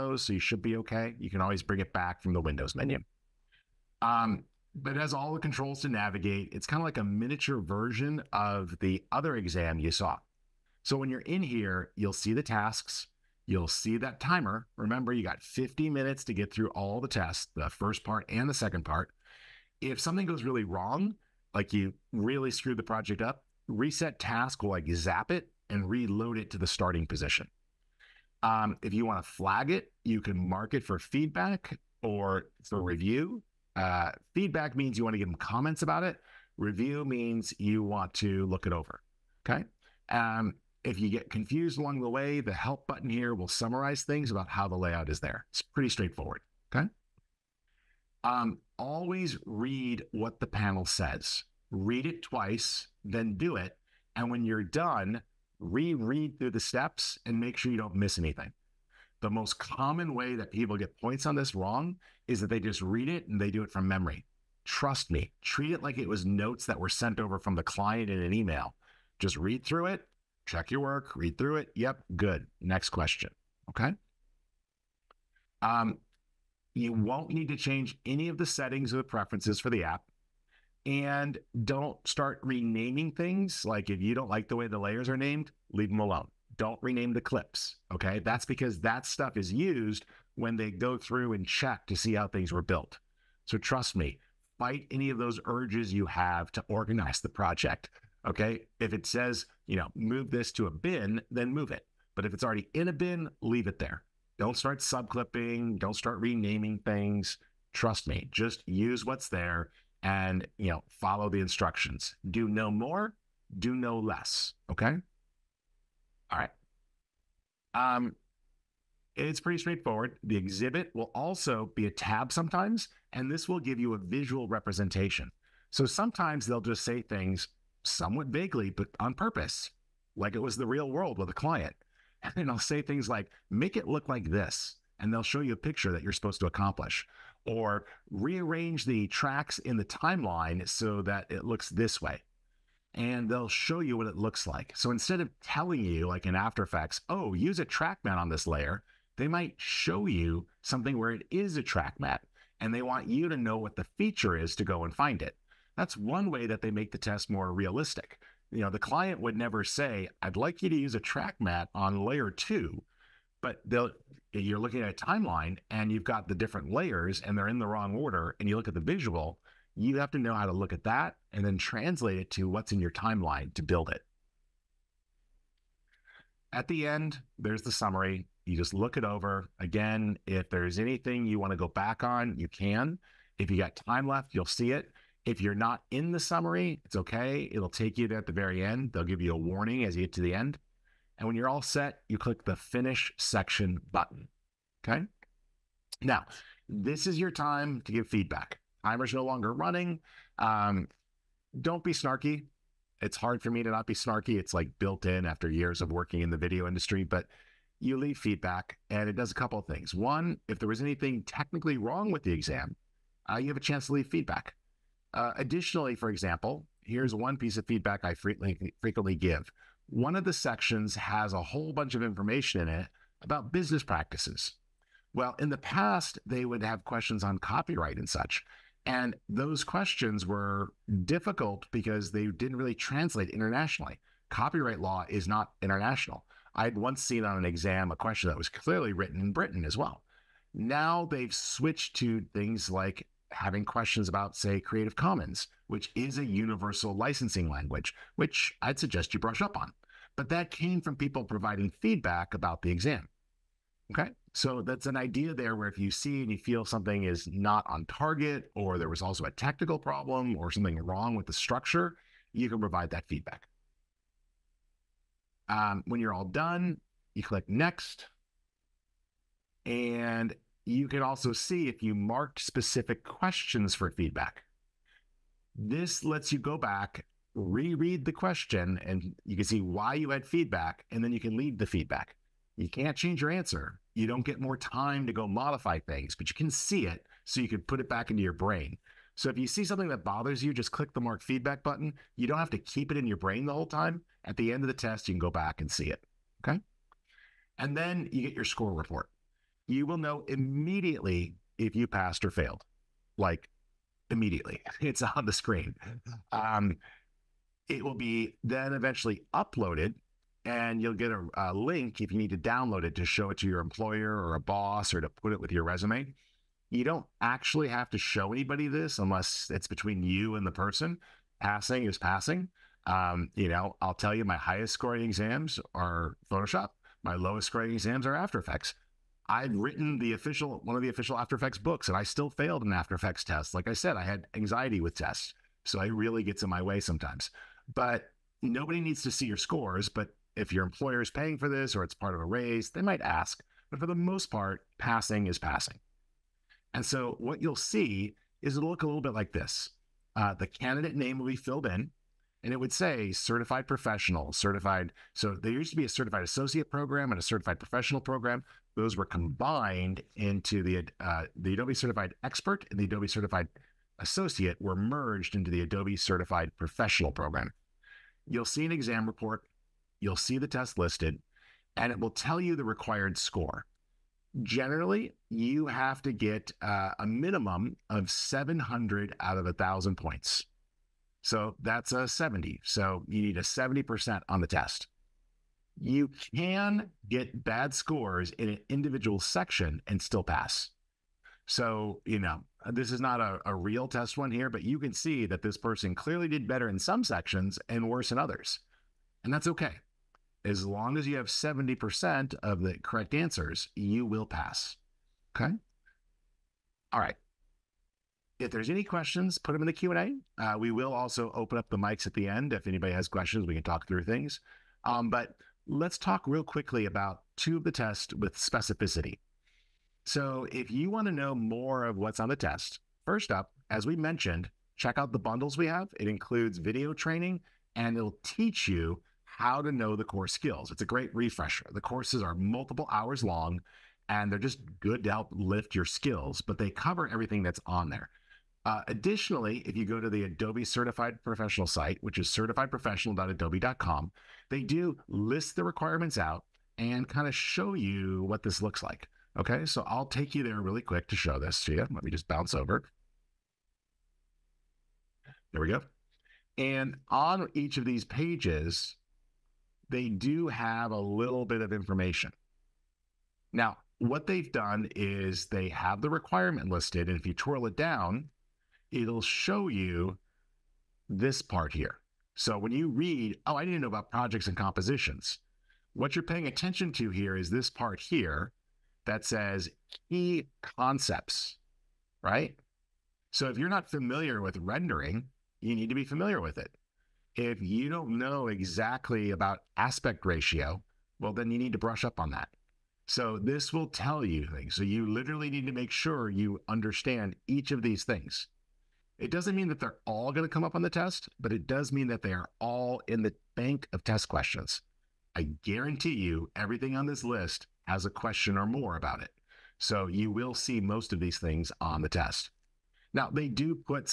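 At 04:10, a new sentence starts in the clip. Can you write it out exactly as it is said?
But that came from people providing feedback about the exam.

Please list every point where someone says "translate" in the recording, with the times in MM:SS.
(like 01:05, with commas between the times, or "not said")
02:51, 03:52.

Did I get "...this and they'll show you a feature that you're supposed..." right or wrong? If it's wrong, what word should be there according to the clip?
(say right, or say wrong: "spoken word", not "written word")
wrong: "picture", not "feature".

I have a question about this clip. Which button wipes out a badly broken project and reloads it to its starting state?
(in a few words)
Reset task.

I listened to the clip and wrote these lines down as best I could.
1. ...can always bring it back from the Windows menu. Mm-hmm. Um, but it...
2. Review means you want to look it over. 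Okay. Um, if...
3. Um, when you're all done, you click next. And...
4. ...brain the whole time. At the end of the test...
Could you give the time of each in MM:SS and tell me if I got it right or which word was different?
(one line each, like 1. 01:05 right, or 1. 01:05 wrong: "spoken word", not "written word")
1. 00:01 right
2. 00:36 right
3. 04:25 right
4. 04:53 right.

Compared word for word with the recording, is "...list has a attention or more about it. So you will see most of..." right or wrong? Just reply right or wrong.
wrong.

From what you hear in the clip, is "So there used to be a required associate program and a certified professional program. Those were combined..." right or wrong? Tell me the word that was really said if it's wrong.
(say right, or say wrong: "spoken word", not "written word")
wrong: "certified", not "required".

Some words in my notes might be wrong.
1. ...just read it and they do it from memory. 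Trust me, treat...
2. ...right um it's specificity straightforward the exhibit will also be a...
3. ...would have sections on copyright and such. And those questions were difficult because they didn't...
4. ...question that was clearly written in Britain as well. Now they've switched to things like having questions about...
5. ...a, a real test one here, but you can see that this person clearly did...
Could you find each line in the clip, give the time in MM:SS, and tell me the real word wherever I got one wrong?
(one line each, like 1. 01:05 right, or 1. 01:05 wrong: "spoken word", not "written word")
1. 01:02 right
2. 01:56 wrong: "pretty", not "specificity"
3. 03:46 wrong: "questions", not "sections"
4. 03:57 right
5. 06:33 right.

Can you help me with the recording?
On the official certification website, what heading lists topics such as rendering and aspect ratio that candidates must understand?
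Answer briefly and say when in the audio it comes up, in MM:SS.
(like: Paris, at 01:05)
Key concepts, at 08:00.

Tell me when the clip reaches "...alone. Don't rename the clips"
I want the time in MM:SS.
01:25.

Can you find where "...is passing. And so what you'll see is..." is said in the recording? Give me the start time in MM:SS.
05:45.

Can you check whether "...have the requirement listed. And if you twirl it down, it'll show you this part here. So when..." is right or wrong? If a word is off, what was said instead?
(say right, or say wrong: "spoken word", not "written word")
right.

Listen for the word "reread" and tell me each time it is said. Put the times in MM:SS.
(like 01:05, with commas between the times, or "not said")
00:55, 04:37.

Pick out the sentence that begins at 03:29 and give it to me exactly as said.
One, if there was anything technically wrong with the exam, uh, you have a chance to leave feedback.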